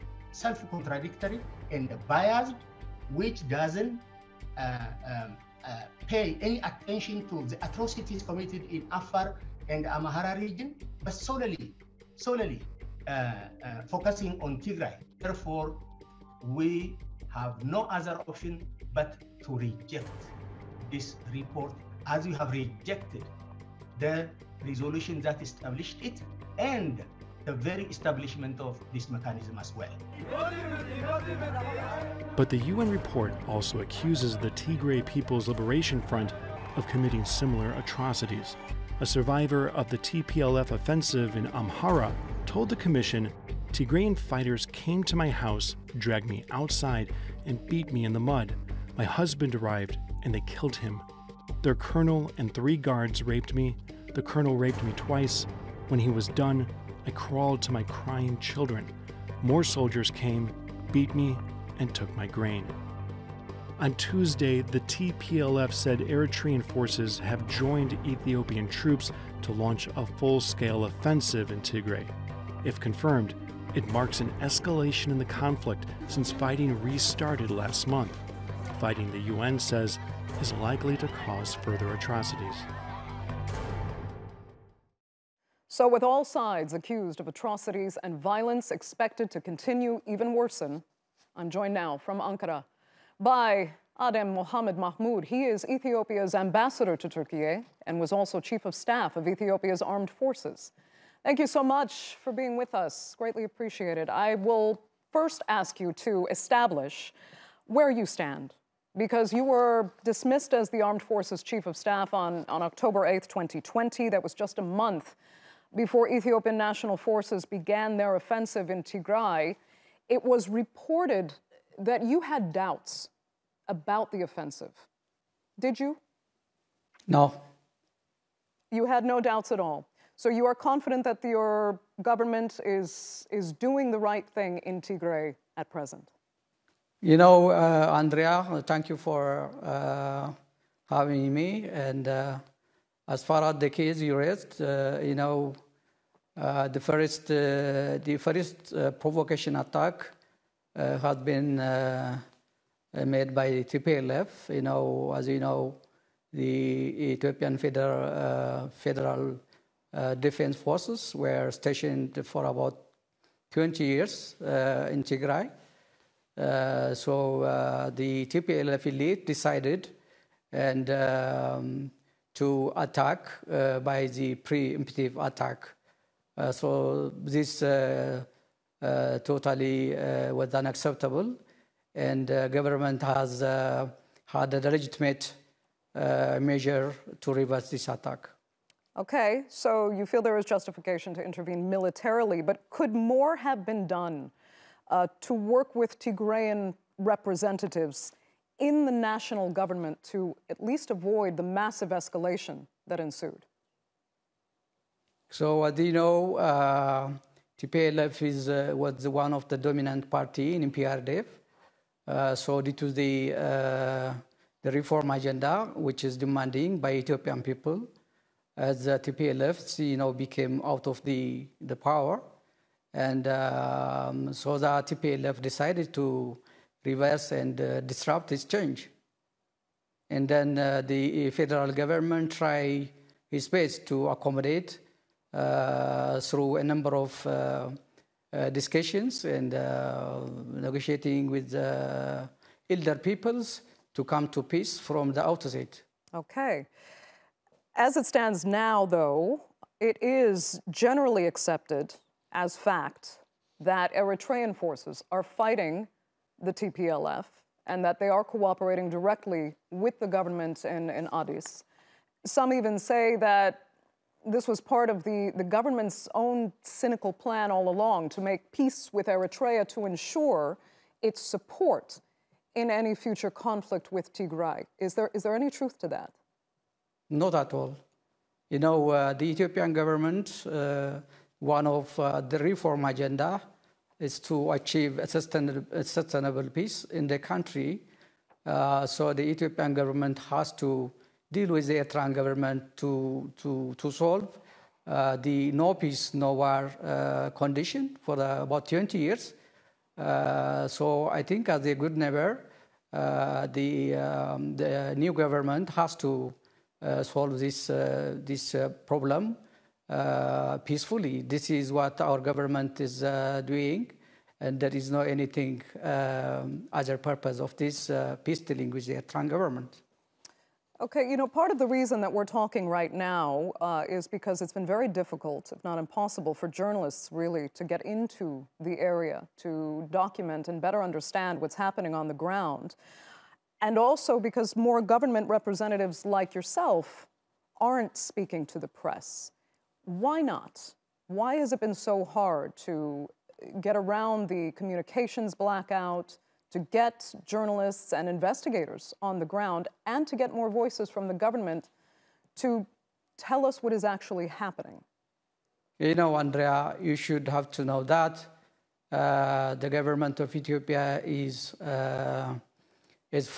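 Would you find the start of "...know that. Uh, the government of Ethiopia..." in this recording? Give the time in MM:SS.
05:57.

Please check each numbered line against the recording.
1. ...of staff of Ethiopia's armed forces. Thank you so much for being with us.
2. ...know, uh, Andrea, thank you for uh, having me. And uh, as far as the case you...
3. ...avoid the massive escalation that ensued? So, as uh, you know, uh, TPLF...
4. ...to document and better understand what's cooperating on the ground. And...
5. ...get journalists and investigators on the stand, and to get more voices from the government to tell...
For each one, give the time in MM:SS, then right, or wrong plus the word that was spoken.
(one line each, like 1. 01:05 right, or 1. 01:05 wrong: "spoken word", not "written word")
1. 01:38 right
2. 02:17 right
3. 03:20 right
4. 05:29 wrong: "happening", not "cooperating"
5. 05:46 wrong: "ground", not "stand".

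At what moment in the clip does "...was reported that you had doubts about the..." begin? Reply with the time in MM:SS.
02:00.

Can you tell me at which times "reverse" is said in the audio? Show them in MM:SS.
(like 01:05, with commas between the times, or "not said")
03:07, 03:46.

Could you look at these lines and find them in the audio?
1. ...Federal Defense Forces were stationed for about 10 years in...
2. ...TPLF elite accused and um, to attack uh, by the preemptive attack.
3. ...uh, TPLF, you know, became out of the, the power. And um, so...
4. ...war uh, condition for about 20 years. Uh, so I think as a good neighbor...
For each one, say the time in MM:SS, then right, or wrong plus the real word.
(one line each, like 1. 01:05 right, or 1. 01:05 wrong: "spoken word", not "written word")
1. 02:38 wrong: "20", not "10"
2. 02:48 wrong: "decided", not "accused"
3. 03:38 right
4. 04:56 right.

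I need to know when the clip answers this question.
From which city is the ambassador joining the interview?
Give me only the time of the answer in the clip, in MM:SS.
01:32.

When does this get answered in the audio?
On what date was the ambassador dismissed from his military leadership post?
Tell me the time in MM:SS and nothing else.
01:52.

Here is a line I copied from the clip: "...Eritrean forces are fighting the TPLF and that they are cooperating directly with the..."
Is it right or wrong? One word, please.
right.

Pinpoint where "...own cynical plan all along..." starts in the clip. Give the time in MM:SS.
04:26.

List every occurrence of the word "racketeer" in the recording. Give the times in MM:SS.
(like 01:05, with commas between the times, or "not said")
not said.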